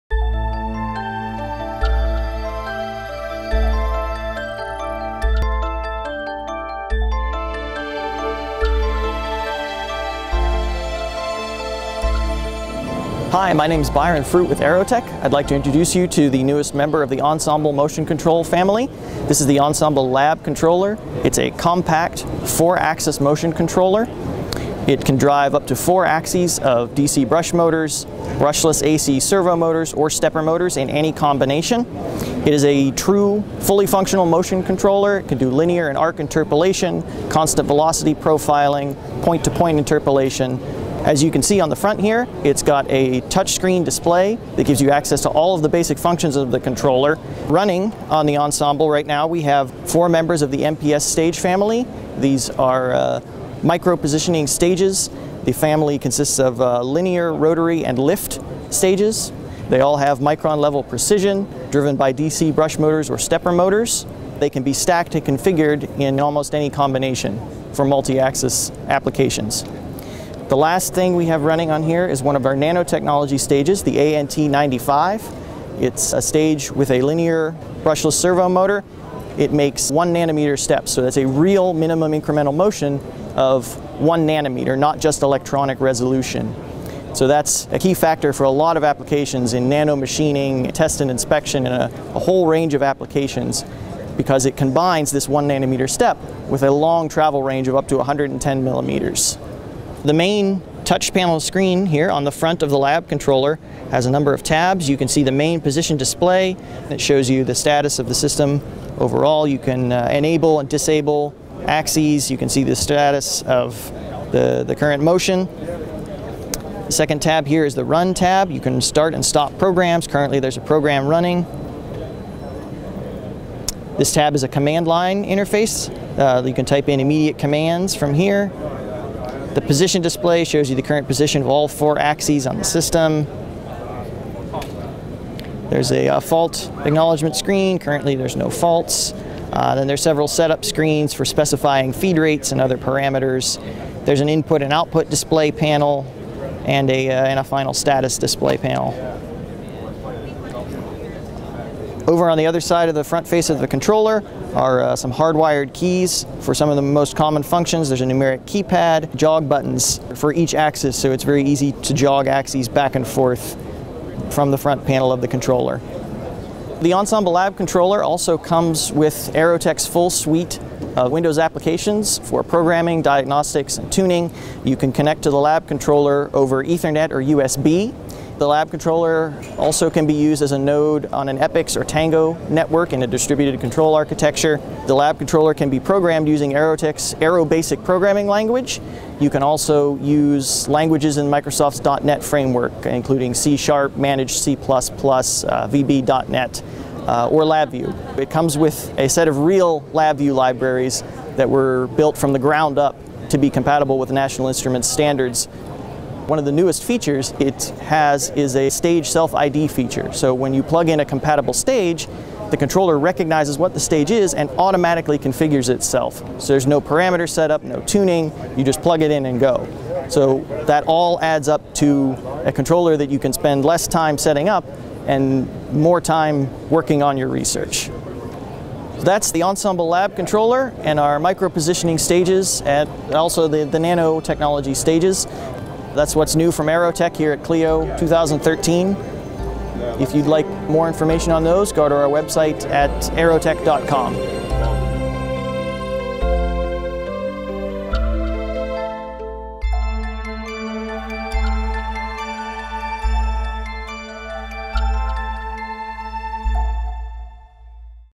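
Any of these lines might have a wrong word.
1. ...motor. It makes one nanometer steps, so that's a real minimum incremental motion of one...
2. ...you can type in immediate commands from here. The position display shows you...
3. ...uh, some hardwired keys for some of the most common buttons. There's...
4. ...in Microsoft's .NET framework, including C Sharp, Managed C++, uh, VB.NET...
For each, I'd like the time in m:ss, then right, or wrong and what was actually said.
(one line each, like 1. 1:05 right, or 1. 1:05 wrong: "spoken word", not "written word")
1. 1:18 right
2. 2:06 right
3. 2:34 wrong: "functions", not "buttons"
4. 3:11 right.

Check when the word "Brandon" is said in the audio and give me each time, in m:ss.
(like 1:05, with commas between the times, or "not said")
not said.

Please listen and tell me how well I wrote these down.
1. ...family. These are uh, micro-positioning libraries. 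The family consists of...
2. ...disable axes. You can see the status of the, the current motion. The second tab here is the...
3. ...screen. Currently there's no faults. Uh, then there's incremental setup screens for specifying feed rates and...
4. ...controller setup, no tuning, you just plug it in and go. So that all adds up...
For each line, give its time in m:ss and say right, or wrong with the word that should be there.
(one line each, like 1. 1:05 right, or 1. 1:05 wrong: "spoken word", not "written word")
1. 0:51 wrong: "stages", not "libraries"
2. 1:50 right
3. 2:17 wrong: "several", not "incremental"
4. 3:36 wrong: "parameter", not "controller".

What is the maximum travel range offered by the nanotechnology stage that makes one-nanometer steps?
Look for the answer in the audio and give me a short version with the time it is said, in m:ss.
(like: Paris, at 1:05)
110 millimeters, at 1:37.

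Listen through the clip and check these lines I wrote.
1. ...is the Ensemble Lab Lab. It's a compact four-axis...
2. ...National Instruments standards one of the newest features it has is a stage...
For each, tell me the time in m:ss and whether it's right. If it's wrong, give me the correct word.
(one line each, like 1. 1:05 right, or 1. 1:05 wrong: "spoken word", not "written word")
1. 0:19 wrong: "Controller", not "Lab"
2. 3:24 right.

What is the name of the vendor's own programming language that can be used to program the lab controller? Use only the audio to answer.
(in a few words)
Aero Basic.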